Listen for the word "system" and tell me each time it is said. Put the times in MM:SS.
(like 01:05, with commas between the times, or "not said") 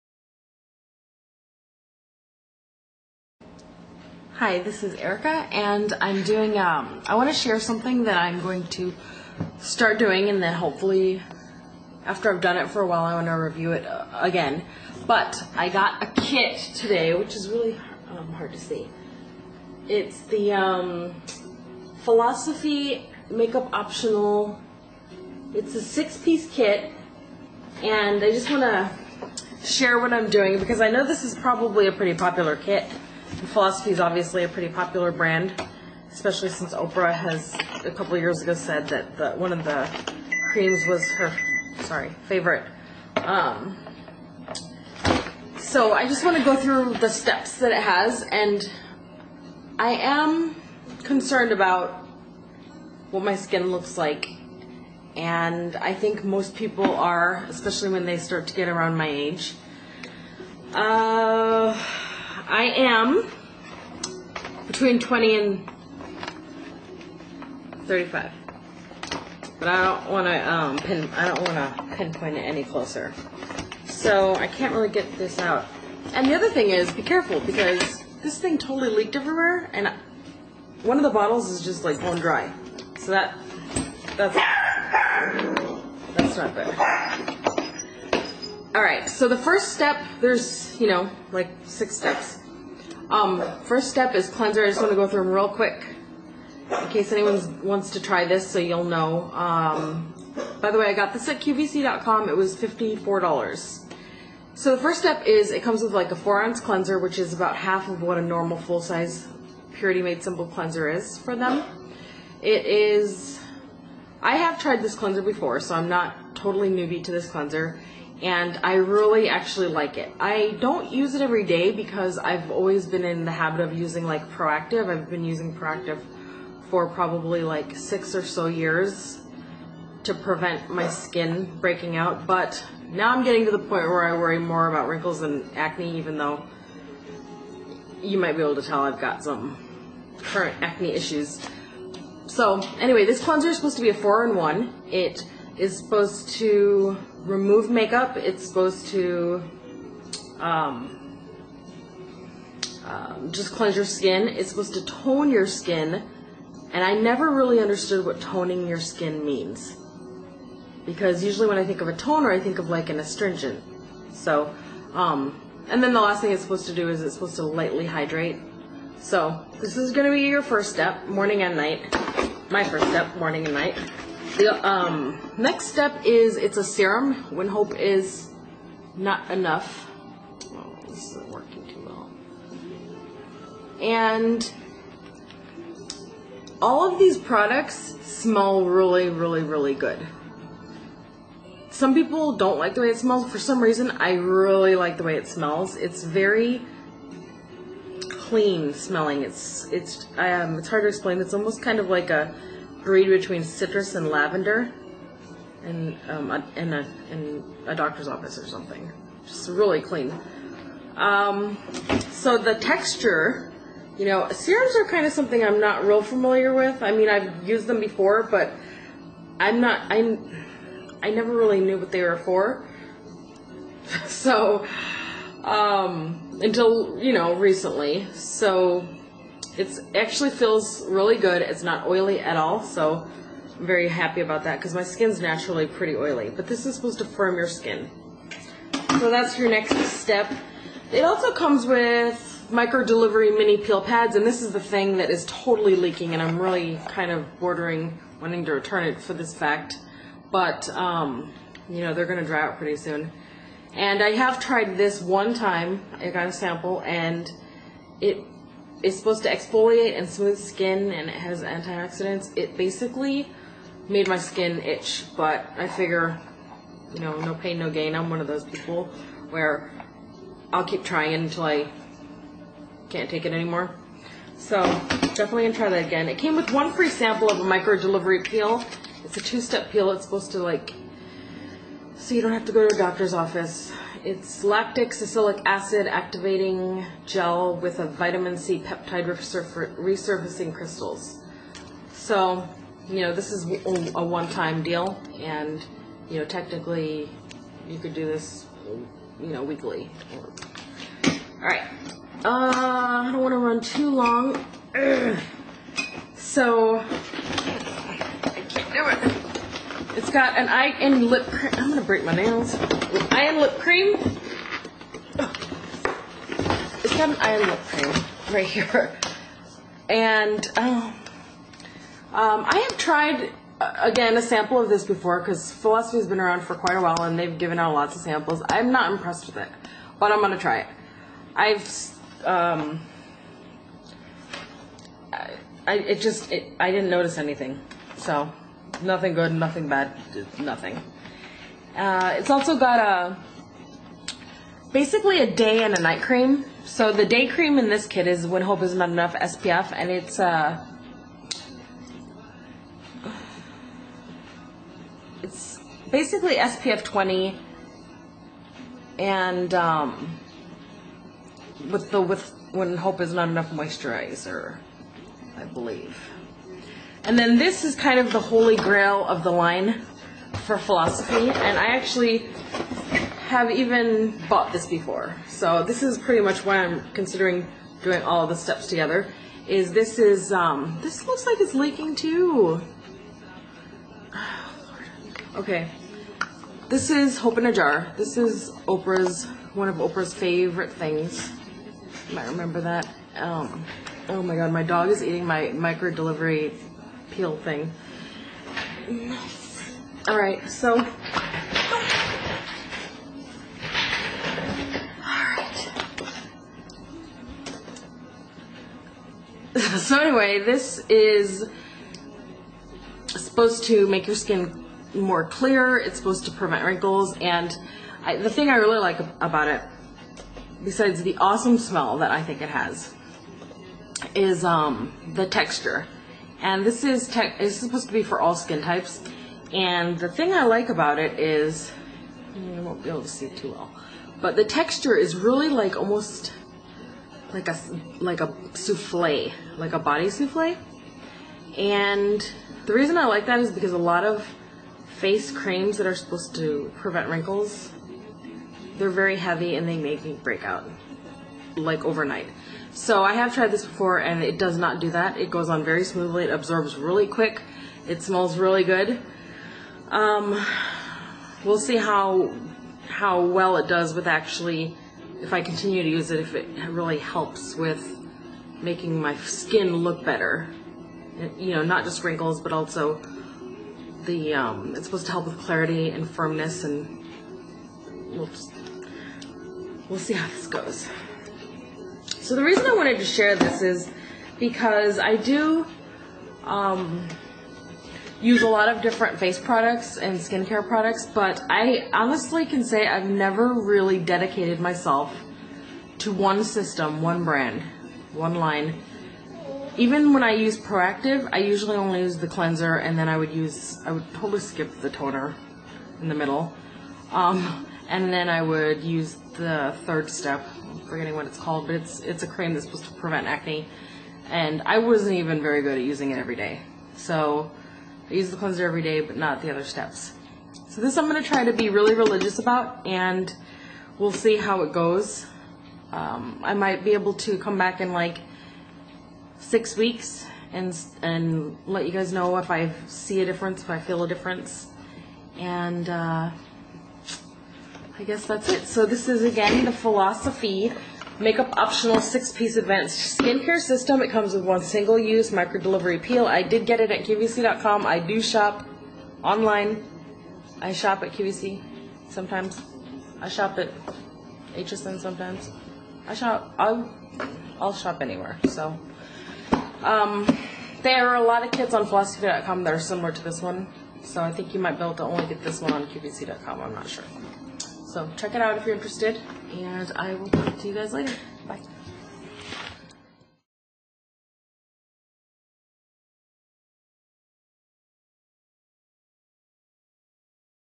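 08:16, 09:03.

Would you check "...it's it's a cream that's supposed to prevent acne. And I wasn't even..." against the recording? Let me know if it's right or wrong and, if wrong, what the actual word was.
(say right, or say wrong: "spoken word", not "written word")
right.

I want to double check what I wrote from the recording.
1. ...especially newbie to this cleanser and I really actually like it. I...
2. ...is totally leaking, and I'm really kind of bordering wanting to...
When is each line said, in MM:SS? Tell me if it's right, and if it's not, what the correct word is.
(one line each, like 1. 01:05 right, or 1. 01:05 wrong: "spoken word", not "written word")
1. 01:56 wrong: "totally", not "especially"
2. 04:05 right.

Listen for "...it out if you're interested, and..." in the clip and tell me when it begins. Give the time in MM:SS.
09:28.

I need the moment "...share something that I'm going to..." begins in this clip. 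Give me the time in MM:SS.
00:07.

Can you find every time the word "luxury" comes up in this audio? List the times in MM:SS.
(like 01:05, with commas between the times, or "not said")
not said.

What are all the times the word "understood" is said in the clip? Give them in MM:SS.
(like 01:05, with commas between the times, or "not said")
02:37.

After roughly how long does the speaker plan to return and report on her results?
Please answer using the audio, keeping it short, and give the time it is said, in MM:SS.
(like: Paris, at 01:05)
6 weeks, at 08:49.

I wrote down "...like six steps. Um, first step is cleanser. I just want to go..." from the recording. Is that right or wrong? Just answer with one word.
right.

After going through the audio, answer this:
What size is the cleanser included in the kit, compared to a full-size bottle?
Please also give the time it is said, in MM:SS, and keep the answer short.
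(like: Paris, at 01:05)
4 ounce, at 01:46.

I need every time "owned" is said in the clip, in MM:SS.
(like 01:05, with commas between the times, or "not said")
not said.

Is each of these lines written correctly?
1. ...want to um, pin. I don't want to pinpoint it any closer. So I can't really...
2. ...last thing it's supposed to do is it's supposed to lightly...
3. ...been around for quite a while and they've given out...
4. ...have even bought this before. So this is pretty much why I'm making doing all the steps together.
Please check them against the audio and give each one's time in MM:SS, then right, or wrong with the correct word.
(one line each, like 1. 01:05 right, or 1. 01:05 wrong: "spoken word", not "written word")
1. 01:10 right
2. 02:46 right
3. 05:26 right
4. 06:13 wrong: "considering", not "making".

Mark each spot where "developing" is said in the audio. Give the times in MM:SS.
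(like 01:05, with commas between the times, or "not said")
not said.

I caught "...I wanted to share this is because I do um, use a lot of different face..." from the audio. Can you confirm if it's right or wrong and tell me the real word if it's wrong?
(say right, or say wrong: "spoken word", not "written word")
right.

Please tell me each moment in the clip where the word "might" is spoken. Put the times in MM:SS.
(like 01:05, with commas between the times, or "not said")
02:18, 06:32, 08:46, 09:24.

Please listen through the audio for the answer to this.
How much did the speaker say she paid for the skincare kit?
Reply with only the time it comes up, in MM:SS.
01:42.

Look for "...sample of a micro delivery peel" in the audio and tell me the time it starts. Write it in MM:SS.
04:36.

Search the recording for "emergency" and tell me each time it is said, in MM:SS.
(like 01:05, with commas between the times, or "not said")
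not said.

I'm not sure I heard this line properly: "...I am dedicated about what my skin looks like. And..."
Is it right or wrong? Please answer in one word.
wrong.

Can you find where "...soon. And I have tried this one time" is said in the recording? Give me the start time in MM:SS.
04:12.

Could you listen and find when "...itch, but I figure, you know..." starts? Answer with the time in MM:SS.
04:24.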